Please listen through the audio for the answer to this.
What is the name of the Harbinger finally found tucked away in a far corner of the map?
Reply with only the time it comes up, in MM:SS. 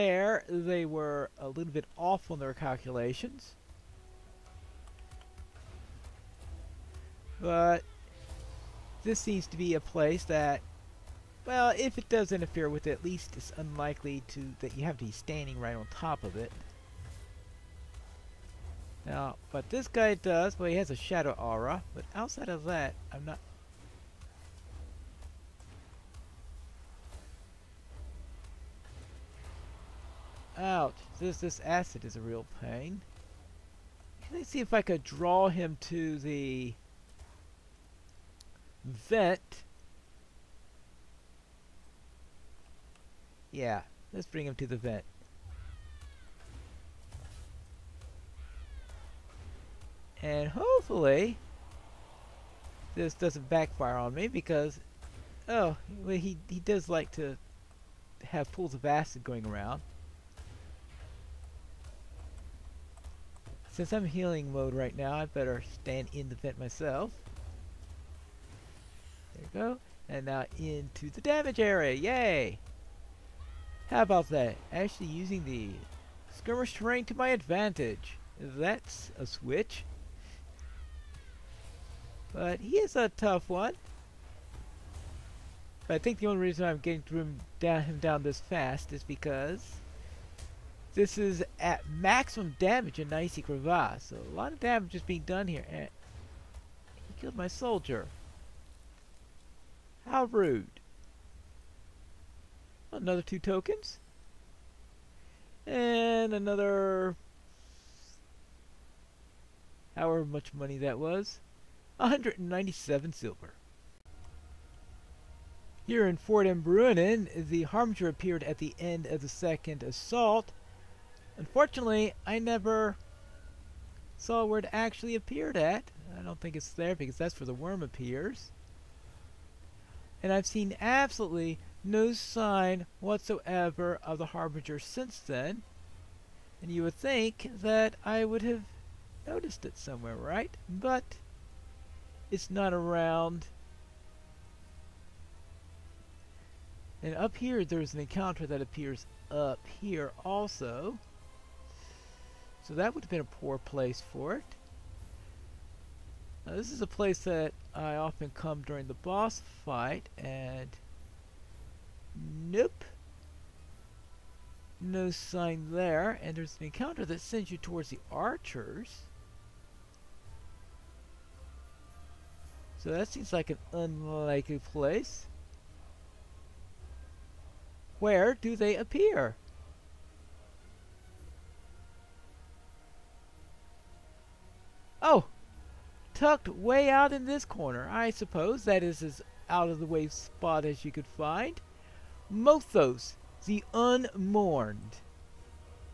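03:12.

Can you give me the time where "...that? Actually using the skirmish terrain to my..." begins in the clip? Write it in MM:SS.
01:14.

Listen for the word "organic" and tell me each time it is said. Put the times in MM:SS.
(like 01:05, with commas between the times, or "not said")
not said.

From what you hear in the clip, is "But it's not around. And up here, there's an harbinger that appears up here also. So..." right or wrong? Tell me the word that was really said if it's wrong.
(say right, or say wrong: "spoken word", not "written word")
wrong: "encounter", not "harbinger".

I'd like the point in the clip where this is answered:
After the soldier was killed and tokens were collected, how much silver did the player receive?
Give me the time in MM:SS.
01:51.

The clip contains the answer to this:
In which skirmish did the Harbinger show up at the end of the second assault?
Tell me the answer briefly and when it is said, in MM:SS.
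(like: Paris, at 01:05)
Ford of Bruinen, at 01:56.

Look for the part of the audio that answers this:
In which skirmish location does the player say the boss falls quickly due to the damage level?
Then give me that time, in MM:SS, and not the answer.
01:33.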